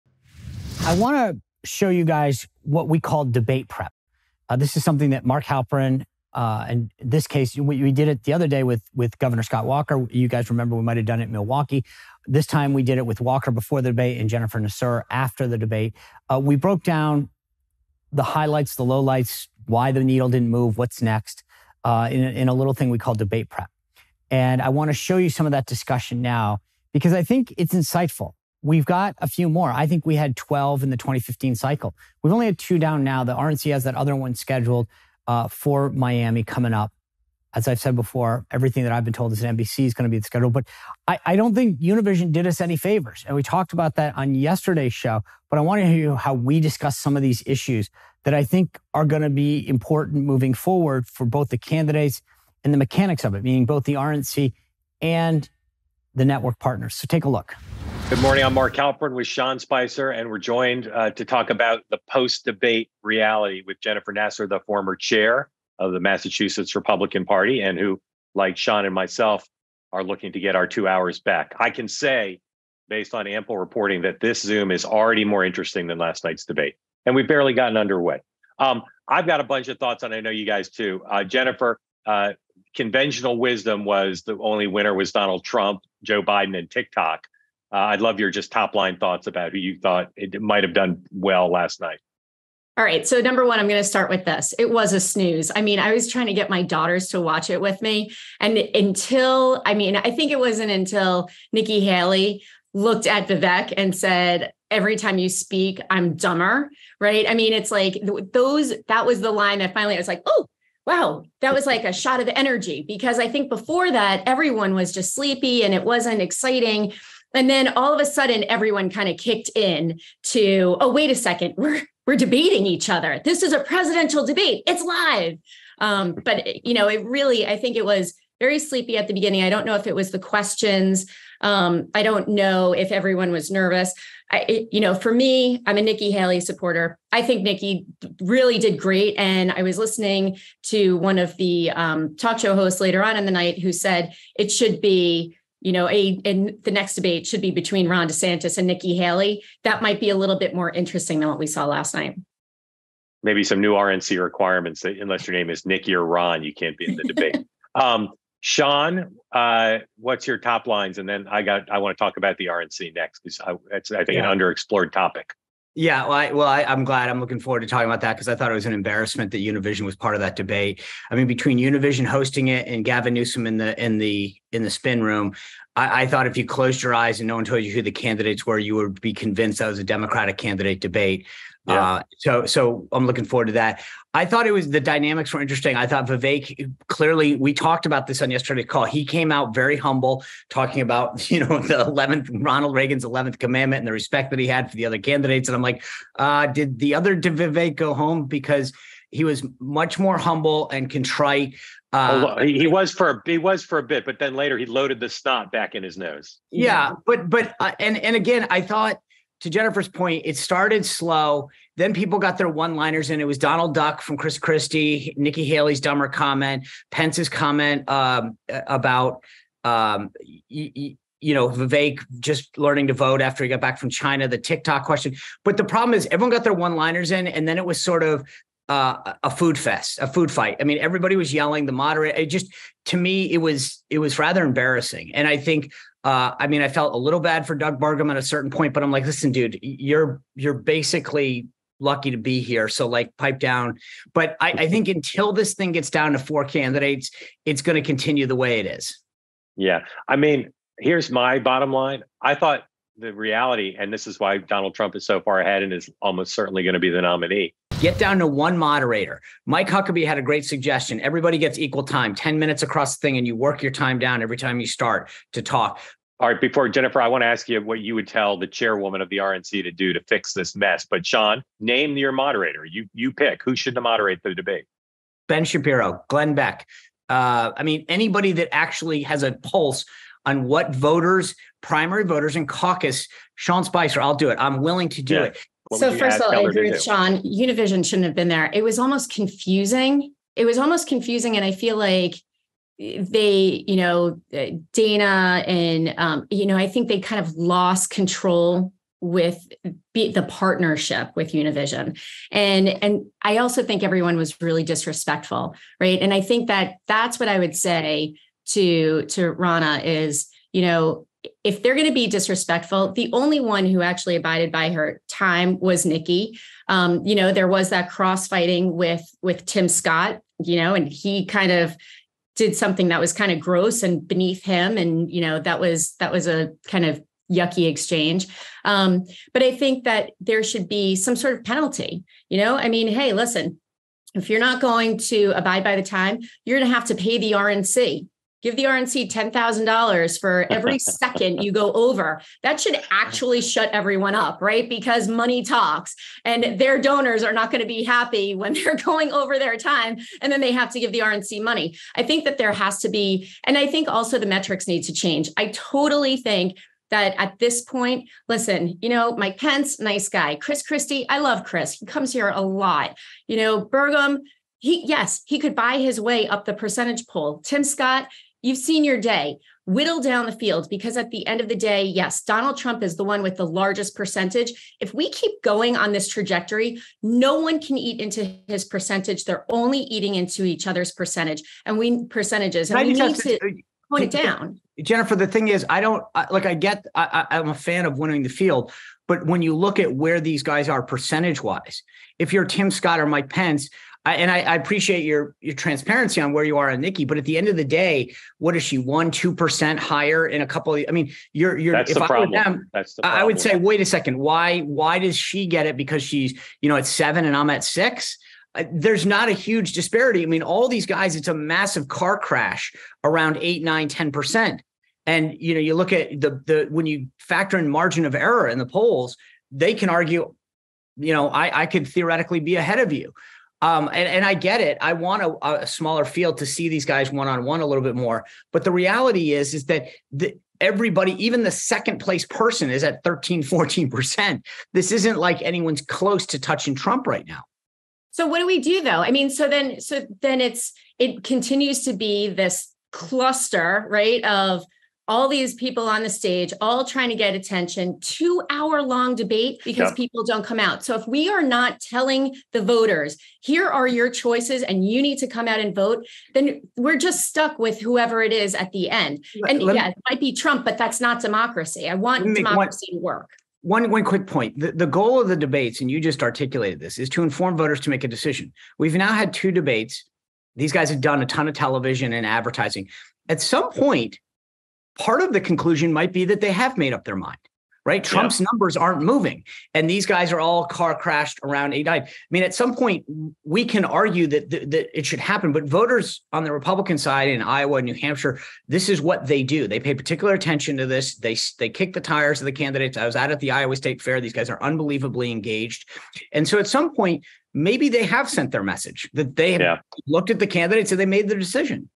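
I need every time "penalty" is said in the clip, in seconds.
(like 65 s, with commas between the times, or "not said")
331 s.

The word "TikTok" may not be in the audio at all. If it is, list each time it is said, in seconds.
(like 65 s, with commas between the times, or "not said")
86 s, 224 s.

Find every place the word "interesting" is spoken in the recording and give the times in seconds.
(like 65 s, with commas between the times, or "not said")
75 s, 150 s, 185 s.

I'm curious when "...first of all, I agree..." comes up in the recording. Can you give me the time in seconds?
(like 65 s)
285 s.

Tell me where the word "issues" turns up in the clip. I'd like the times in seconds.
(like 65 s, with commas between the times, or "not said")
47 s.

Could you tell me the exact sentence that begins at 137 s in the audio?
I think Nikki really did great.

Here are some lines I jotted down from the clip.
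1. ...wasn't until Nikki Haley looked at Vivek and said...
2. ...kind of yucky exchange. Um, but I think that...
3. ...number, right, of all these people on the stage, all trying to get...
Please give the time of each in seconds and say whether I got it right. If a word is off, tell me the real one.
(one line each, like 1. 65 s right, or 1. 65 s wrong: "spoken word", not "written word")
1. 100 s right
2. 326 s right
3. 442 s wrong: "cluster", not "number".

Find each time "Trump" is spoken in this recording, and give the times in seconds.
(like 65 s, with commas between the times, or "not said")
85 s, 254 s, 372 s, 436 s, 460 s, 478 s.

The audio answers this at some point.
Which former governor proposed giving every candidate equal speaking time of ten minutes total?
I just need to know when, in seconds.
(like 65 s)
259 s.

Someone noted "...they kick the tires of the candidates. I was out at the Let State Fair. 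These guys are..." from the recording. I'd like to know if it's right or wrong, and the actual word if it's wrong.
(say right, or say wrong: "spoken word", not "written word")
wrong: "Iowa", not "Let".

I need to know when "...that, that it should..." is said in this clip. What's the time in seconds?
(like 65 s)
484 s.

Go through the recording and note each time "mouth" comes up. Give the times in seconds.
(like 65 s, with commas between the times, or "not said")
not said.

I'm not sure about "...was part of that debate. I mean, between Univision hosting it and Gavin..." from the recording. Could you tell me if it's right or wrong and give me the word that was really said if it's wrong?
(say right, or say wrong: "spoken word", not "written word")
right.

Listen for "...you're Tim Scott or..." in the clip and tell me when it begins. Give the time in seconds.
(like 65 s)
392 s.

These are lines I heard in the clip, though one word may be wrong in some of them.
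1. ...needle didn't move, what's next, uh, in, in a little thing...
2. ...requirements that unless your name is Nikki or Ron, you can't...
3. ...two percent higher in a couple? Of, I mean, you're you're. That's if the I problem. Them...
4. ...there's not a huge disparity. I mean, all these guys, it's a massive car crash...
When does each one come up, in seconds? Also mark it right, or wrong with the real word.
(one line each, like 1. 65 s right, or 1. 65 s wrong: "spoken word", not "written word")
1. 20 s right
2. 154 s right
3. 399 s right
4. 408 s right.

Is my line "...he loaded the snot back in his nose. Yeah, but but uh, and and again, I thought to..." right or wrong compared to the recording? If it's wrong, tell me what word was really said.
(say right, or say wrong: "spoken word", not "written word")
right.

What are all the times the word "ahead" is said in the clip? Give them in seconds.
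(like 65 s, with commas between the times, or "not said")
255 s, 422 s.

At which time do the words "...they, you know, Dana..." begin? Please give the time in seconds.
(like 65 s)
292 s.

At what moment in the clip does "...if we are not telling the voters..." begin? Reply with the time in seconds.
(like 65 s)
450 s.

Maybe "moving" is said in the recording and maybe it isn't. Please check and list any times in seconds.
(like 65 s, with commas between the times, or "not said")
50 s, 479 s.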